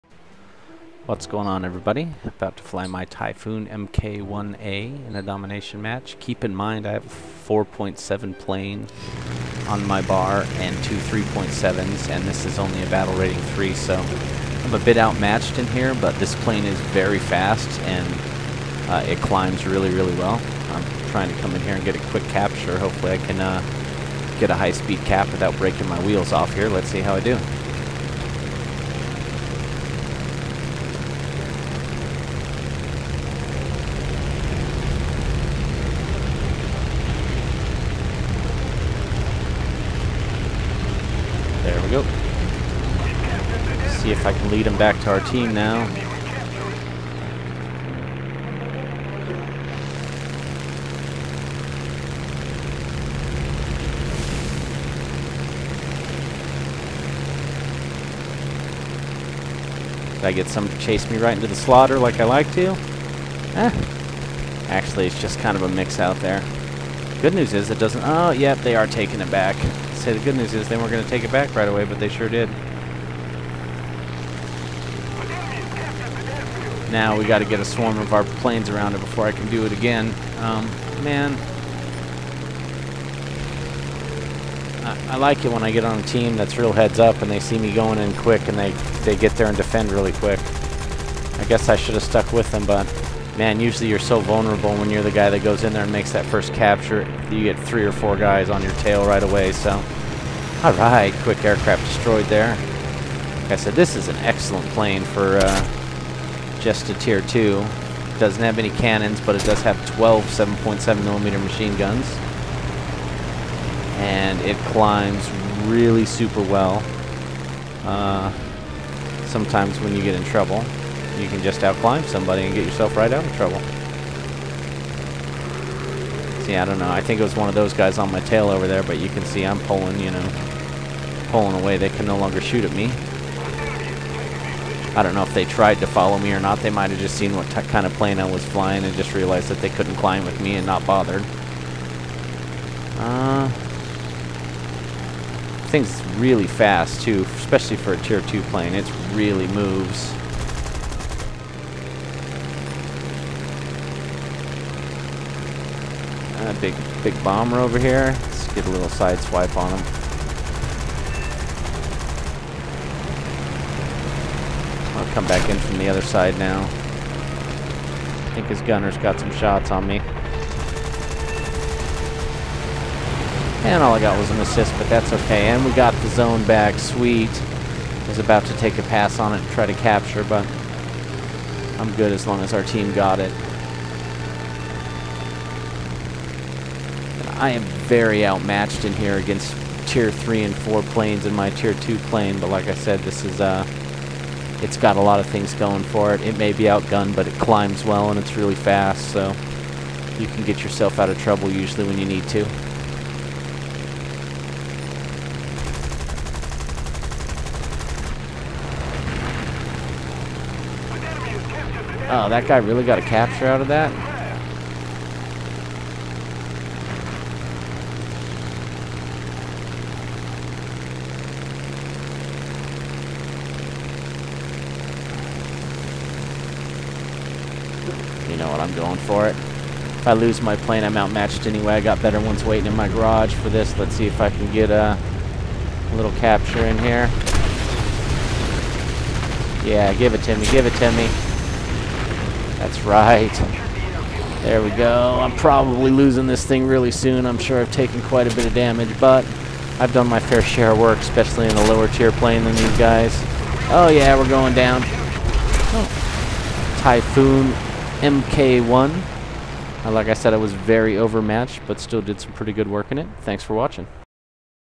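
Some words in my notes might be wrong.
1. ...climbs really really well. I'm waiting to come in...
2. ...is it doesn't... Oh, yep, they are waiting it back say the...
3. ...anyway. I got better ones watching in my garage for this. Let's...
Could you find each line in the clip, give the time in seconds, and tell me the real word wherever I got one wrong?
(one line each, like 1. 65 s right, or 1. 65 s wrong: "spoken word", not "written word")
1. 19 s wrong: "trying", not "waiting"
2. 67 s wrong: "taking", not "waiting"
3. 231 s wrong: "waiting", not "watching".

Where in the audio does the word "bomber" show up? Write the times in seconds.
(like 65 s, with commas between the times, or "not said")
157 s.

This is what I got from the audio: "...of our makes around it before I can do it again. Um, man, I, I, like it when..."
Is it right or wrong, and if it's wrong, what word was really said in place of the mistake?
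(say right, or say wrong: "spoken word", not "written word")
wrong: "planes", not "makes".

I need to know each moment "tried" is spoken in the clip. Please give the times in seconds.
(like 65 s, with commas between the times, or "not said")
135 s.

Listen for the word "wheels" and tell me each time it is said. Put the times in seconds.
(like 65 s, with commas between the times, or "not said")
26 s.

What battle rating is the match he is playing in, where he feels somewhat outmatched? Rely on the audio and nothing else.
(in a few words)
3.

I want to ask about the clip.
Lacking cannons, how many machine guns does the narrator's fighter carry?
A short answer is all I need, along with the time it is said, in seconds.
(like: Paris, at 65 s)
12, at 109 s.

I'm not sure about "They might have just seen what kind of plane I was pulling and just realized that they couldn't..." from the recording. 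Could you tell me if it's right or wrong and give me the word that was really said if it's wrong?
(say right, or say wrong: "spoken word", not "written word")
wrong: "flying", not "pulling".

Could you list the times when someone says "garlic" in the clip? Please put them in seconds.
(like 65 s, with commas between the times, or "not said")
not said.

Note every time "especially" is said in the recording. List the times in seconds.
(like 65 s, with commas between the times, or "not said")
147 s, 250 s.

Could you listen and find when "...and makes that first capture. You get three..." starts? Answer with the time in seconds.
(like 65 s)
95 s.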